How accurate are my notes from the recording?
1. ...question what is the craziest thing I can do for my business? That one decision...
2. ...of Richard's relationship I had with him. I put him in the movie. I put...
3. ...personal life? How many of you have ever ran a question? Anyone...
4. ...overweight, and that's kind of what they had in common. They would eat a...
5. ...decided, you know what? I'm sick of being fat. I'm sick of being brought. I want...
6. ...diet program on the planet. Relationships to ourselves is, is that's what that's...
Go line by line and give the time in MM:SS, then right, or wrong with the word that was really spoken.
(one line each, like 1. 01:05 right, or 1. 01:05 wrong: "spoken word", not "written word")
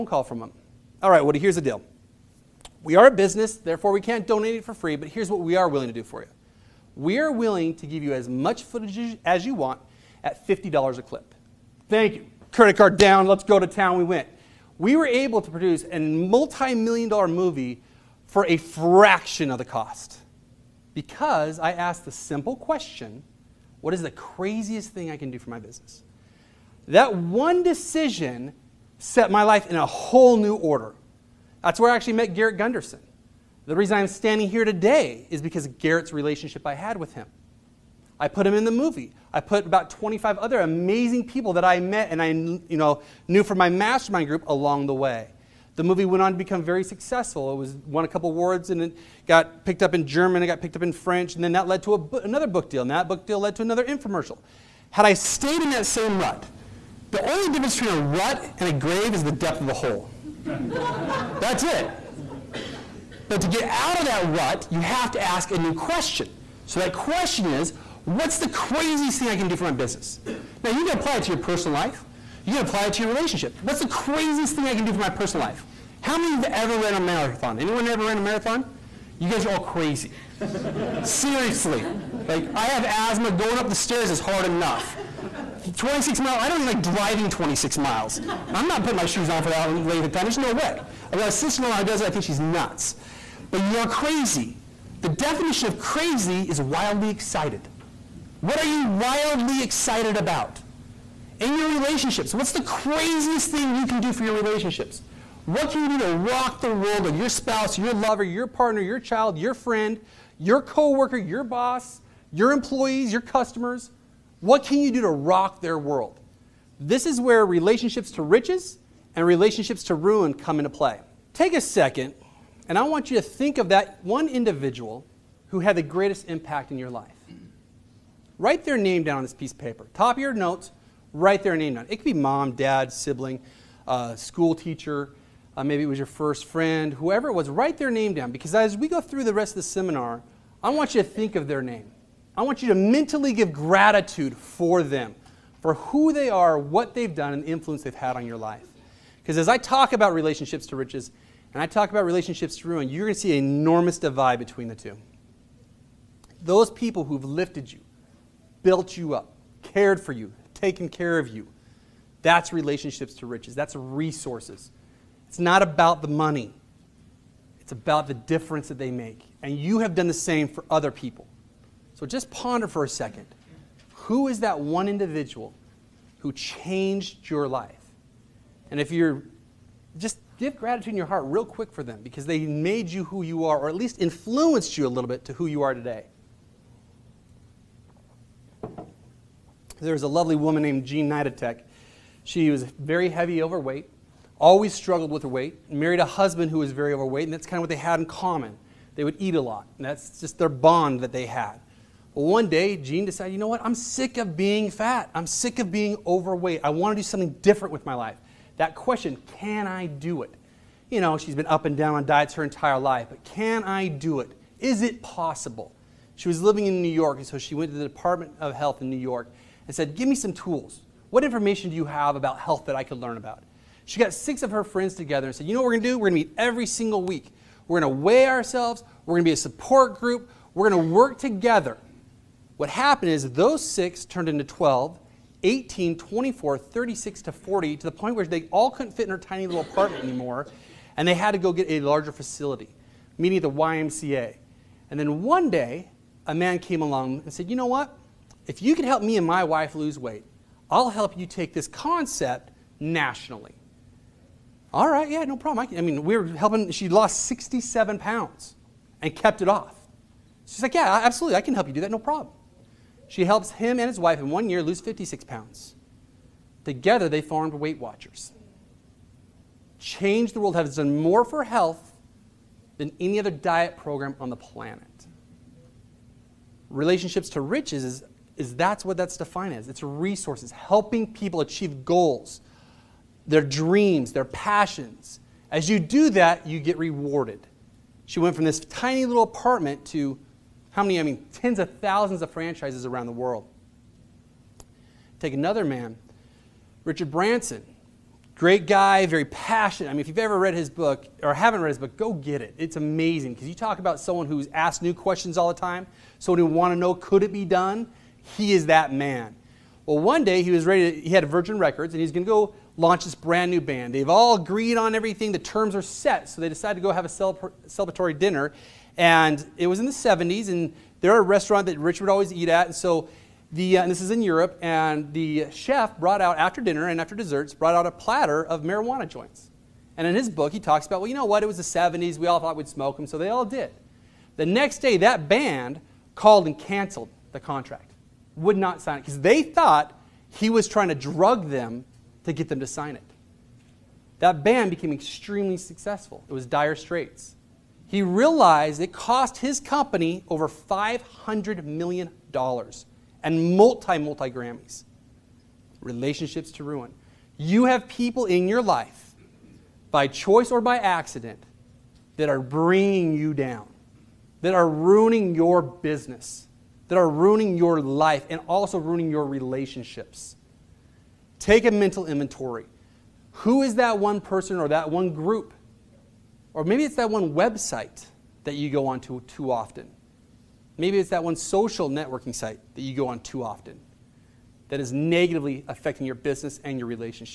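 1. 00:22 right
2. 00:35 wrong: "Garrett", not "Richard"
3. 01:15 wrong: "marathon", not "question"
4. 03:16 right
5. 03:23 wrong: "overweight", not "brought"
6. 04:33 wrong: "riches", not "ourselves".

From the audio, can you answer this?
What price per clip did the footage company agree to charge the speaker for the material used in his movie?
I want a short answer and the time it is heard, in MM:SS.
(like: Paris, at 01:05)
$50, at 00:10.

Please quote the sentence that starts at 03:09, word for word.
There was a lovely woman named Jean Nidetch.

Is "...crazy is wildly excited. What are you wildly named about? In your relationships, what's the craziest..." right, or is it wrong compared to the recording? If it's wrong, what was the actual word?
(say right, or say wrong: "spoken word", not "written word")
wrong: "excited", not "named".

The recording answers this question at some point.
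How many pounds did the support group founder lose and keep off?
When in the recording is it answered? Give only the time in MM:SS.
04:17.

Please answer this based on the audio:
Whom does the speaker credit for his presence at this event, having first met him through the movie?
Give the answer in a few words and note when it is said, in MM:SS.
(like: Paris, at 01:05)
Garrett Gunderson, at 00:32.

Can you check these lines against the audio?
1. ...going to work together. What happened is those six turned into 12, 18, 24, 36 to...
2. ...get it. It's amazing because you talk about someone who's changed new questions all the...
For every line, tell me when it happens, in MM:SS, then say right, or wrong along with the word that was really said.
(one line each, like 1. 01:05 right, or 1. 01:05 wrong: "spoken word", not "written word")
1. 03:50 right
2. 05:02 wrong: "asked", not "changed".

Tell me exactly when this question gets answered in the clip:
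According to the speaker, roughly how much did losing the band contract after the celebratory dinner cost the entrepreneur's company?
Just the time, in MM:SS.
05:50.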